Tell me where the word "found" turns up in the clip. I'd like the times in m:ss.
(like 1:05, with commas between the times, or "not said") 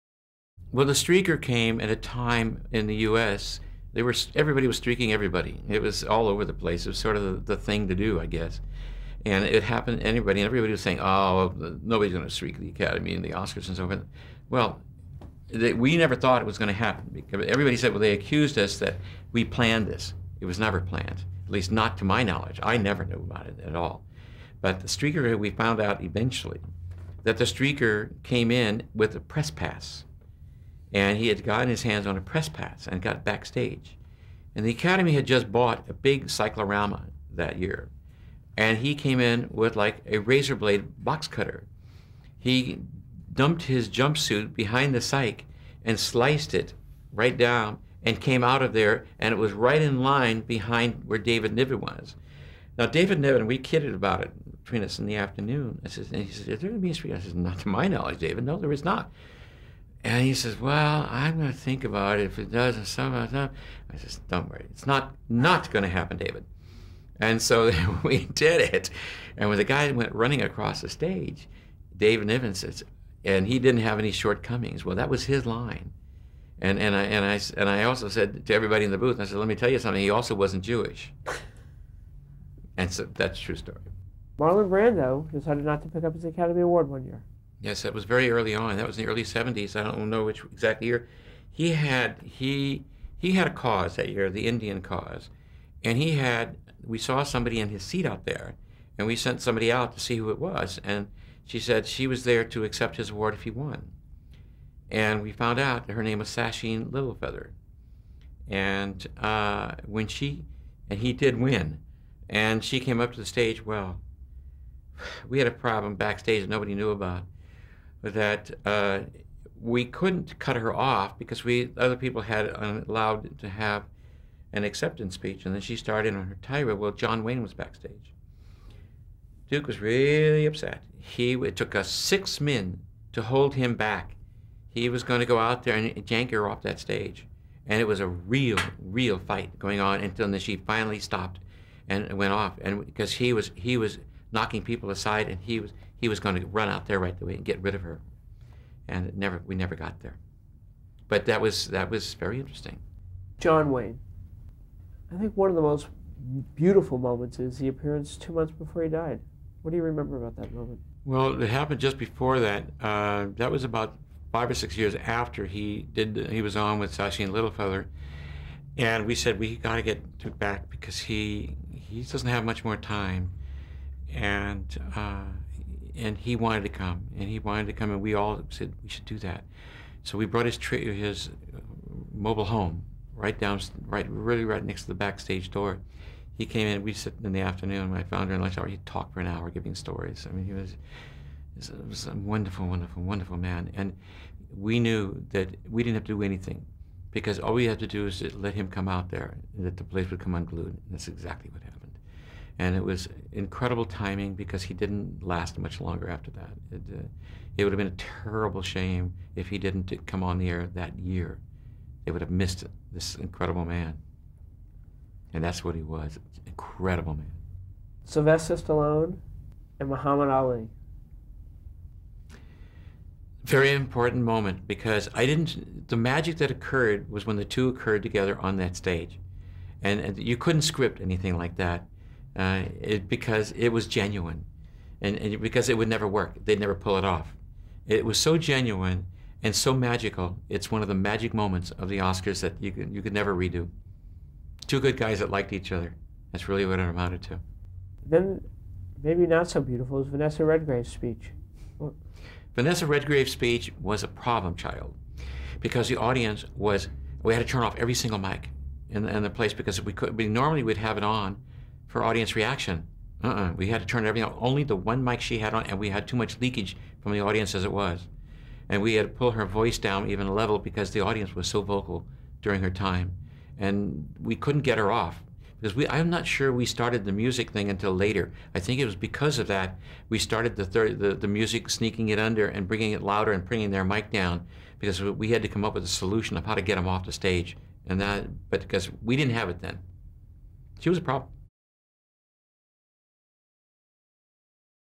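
0:25, 1:45, 3:08.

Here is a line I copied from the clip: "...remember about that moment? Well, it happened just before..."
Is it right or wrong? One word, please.
right.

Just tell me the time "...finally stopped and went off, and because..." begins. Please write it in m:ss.
2:20.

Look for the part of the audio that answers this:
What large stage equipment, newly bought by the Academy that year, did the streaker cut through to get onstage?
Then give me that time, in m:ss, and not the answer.
0:36.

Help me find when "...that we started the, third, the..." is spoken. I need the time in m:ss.
4:39.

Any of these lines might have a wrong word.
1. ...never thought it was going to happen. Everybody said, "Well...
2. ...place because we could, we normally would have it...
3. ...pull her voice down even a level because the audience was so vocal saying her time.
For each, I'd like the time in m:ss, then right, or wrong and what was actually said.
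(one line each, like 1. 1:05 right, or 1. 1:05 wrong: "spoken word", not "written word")
1. 0:15 right
2. 4:19 right
3. 4:29 wrong: "during", not "saying".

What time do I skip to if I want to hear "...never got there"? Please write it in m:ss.
2:29.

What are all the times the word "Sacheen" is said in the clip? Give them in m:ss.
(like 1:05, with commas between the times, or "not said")
1:46, 2:46.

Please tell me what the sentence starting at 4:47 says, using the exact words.
And that, but because we didn't have it then.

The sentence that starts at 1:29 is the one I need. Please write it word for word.
I don't know which exact year.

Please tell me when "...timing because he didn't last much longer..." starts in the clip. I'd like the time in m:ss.
3:23.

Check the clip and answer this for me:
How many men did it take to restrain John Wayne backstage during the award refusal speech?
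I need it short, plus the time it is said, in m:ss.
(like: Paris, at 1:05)
6, at 2:11.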